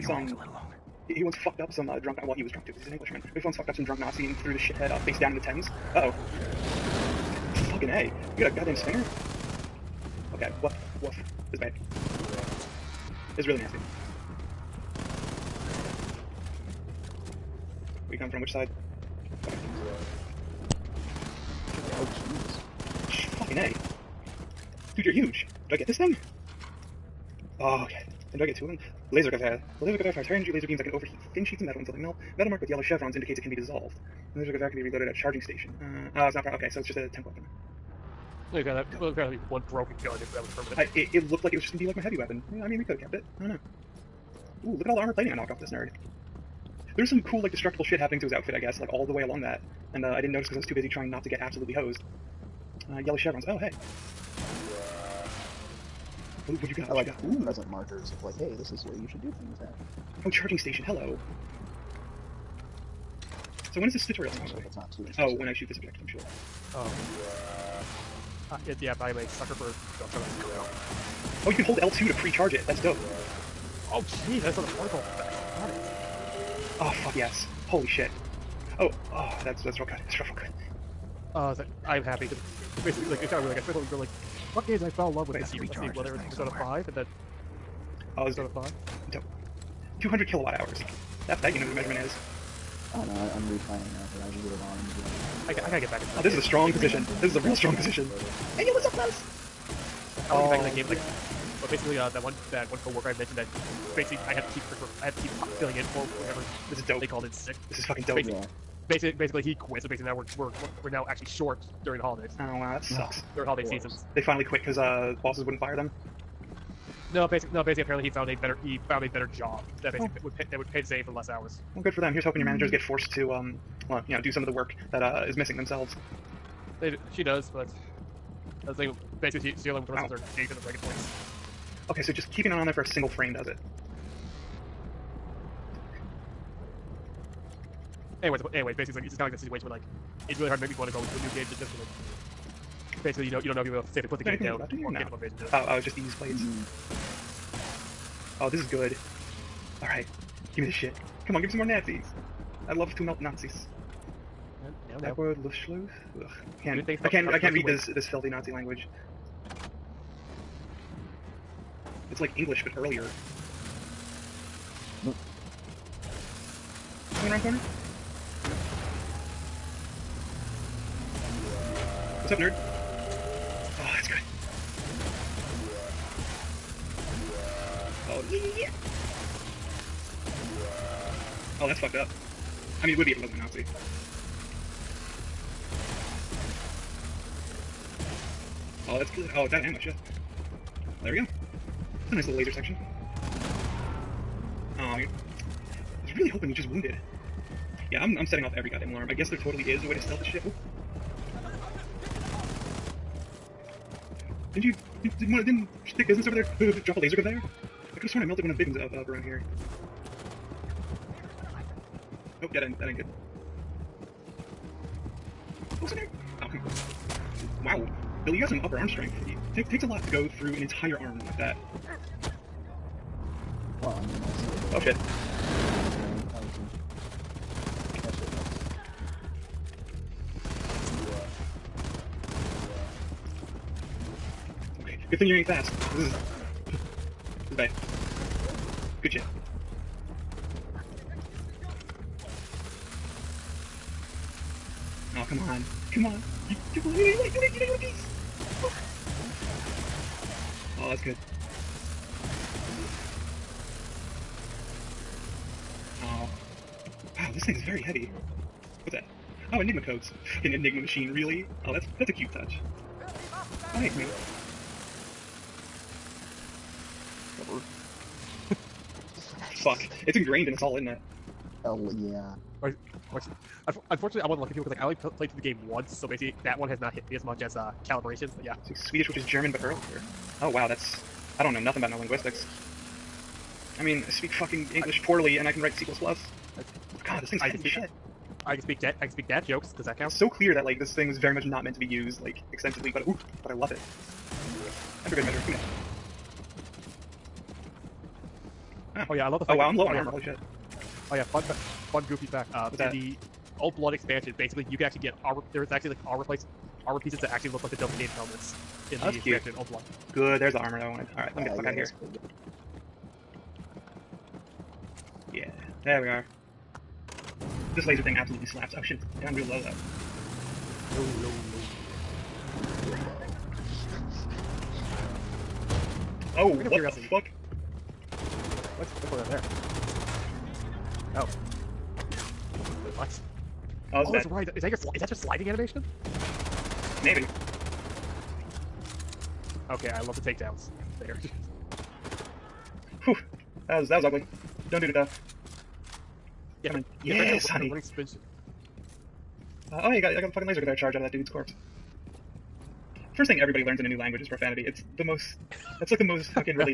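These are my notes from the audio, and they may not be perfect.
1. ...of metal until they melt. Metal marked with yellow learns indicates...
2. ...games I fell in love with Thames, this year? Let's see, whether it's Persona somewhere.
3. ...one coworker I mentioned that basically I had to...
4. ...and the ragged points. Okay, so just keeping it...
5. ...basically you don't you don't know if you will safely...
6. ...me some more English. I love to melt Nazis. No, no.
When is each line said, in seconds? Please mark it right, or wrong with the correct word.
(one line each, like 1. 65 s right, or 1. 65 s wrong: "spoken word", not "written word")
1. 31 s wrong: "chevrons", not "learns"
2. 84 s wrong: "Wait", not "Thames"
3. 102 s right
4. 130 s right
5. 143 s right
6. 151 s wrong: "Nazis", not "English".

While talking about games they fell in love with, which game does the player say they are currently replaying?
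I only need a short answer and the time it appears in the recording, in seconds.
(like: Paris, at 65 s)
Horizon Zero Dawn, at 94 s.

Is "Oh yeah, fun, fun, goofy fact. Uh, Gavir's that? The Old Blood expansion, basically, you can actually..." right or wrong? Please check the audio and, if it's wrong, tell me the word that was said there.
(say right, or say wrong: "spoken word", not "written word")
wrong: "What", not "Gavir".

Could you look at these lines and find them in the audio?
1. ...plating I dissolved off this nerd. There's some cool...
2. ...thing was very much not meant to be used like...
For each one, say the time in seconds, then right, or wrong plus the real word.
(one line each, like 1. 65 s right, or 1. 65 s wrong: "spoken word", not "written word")
1. 45 s wrong: "knocked", not "dissolved"
2. 290 s right.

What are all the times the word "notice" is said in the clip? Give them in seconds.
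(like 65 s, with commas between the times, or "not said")
50 s.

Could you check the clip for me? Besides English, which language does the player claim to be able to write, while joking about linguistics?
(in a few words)
C++.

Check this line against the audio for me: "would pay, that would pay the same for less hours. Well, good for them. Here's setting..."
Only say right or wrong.
wrong.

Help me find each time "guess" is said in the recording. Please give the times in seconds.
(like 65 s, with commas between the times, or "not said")
48 s, 199 s.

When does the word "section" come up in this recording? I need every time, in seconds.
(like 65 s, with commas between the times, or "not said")
192 s.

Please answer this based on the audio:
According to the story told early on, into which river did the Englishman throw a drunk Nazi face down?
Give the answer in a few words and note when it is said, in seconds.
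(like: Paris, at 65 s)
Thames, at 5 s.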